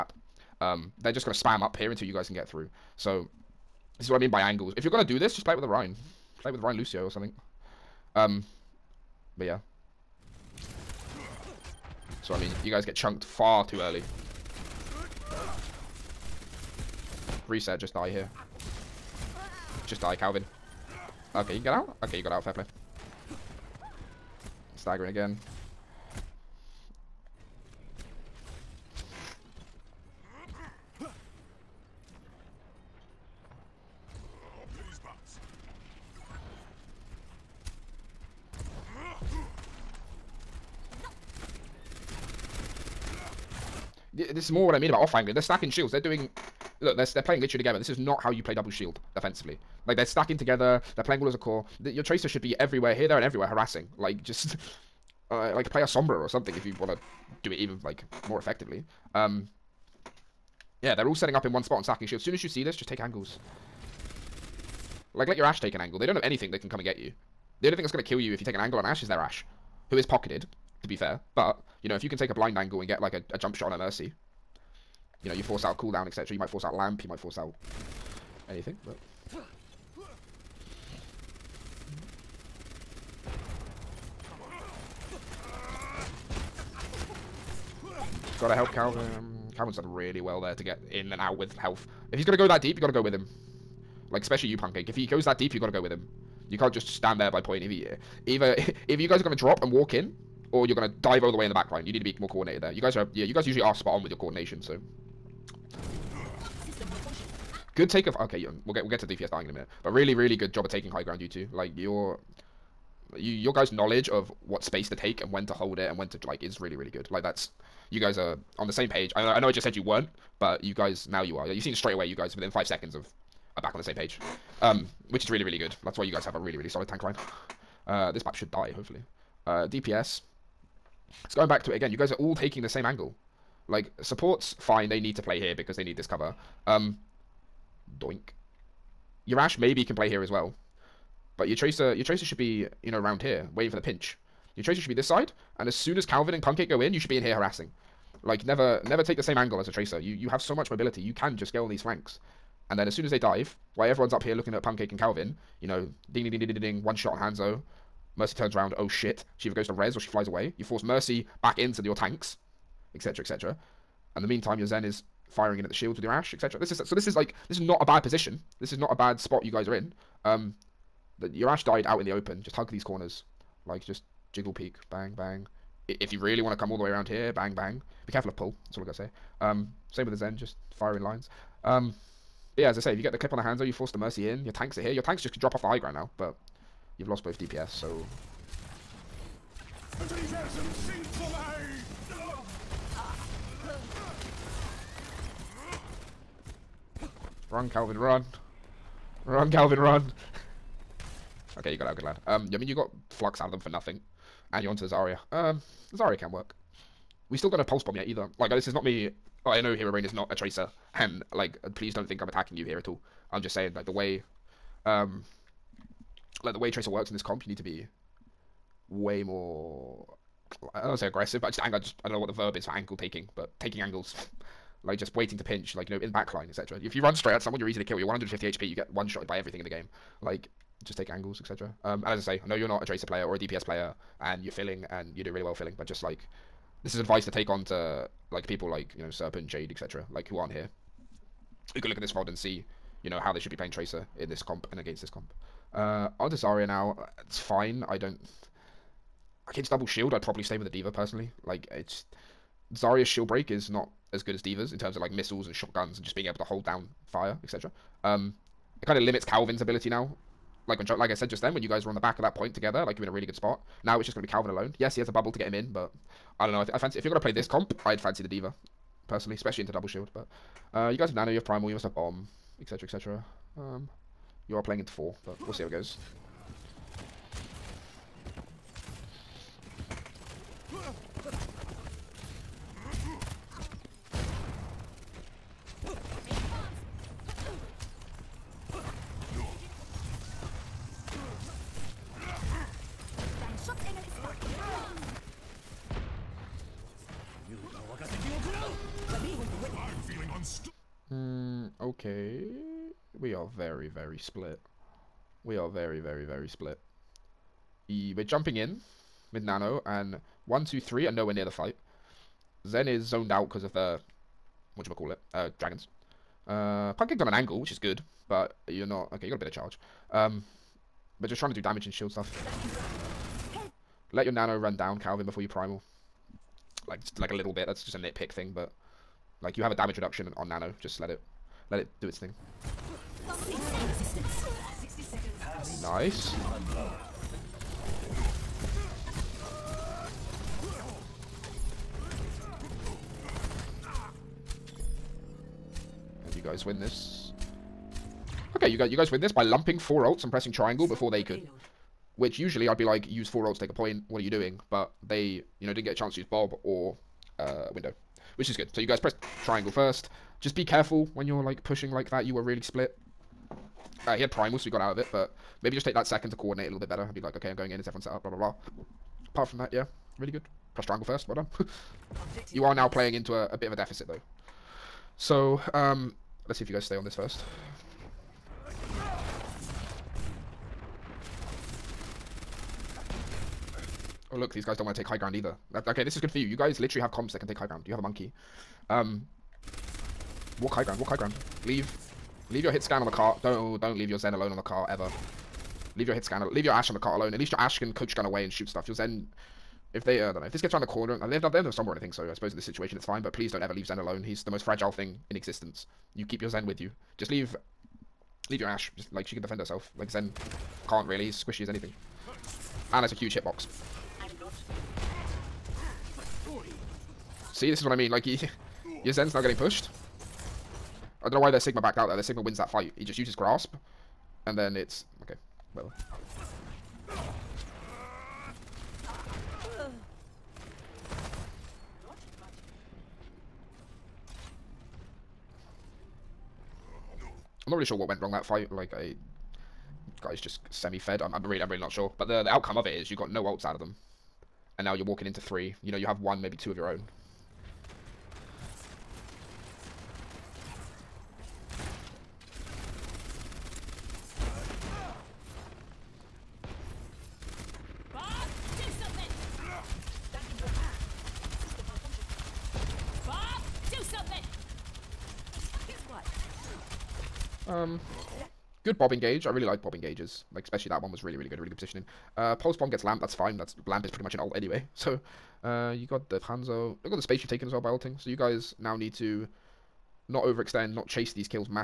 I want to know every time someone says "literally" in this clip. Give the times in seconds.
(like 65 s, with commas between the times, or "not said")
47 s, 386 s.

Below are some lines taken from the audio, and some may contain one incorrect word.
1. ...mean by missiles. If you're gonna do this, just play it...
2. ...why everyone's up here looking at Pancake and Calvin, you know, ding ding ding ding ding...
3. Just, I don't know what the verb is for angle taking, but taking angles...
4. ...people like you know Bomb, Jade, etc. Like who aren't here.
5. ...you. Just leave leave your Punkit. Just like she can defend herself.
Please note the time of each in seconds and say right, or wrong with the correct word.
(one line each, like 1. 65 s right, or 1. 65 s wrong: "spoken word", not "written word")
1. 4 s wrong: "angles", not "missiles"
2. 153 s right
3. 221 s right
4. 238 s wrong: "Serpent", not "Bomb"
5. 406 s wrong: "Ashe", not "Punkit".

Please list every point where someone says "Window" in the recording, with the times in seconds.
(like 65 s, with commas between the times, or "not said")
357 s.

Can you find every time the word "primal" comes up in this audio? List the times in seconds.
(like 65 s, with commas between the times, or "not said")
271 s, 325 s, 364 s.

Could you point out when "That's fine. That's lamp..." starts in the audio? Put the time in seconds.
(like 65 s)
473 s.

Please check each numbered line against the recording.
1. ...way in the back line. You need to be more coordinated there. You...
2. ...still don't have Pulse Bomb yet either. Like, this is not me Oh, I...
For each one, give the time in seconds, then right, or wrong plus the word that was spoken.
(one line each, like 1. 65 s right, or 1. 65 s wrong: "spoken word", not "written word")
1. 101 s right
2. 207 s right.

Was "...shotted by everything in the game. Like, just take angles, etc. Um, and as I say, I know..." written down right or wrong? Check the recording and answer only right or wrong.
right.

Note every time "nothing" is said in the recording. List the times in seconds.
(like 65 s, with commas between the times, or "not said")
203 s.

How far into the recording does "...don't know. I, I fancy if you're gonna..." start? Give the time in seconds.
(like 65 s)
266 s.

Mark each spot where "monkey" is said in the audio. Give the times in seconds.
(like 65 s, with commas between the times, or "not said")
388 s.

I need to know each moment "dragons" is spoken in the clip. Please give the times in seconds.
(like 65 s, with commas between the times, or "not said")
315 s.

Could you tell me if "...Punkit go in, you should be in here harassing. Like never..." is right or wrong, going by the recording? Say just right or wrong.
right.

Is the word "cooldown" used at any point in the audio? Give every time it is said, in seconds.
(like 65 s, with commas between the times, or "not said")
75 s.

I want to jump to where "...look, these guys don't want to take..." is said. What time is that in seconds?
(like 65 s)
384 s.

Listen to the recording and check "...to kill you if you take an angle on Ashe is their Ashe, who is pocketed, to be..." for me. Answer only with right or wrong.
right.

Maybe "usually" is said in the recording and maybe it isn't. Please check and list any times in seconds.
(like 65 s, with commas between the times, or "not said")
103 s, 352 s.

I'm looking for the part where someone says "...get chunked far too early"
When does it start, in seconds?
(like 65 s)
12 s.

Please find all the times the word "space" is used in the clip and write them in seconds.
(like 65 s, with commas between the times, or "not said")
114 s, 477 s.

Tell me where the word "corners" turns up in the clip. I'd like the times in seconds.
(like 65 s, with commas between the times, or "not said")
172 s, 400 s.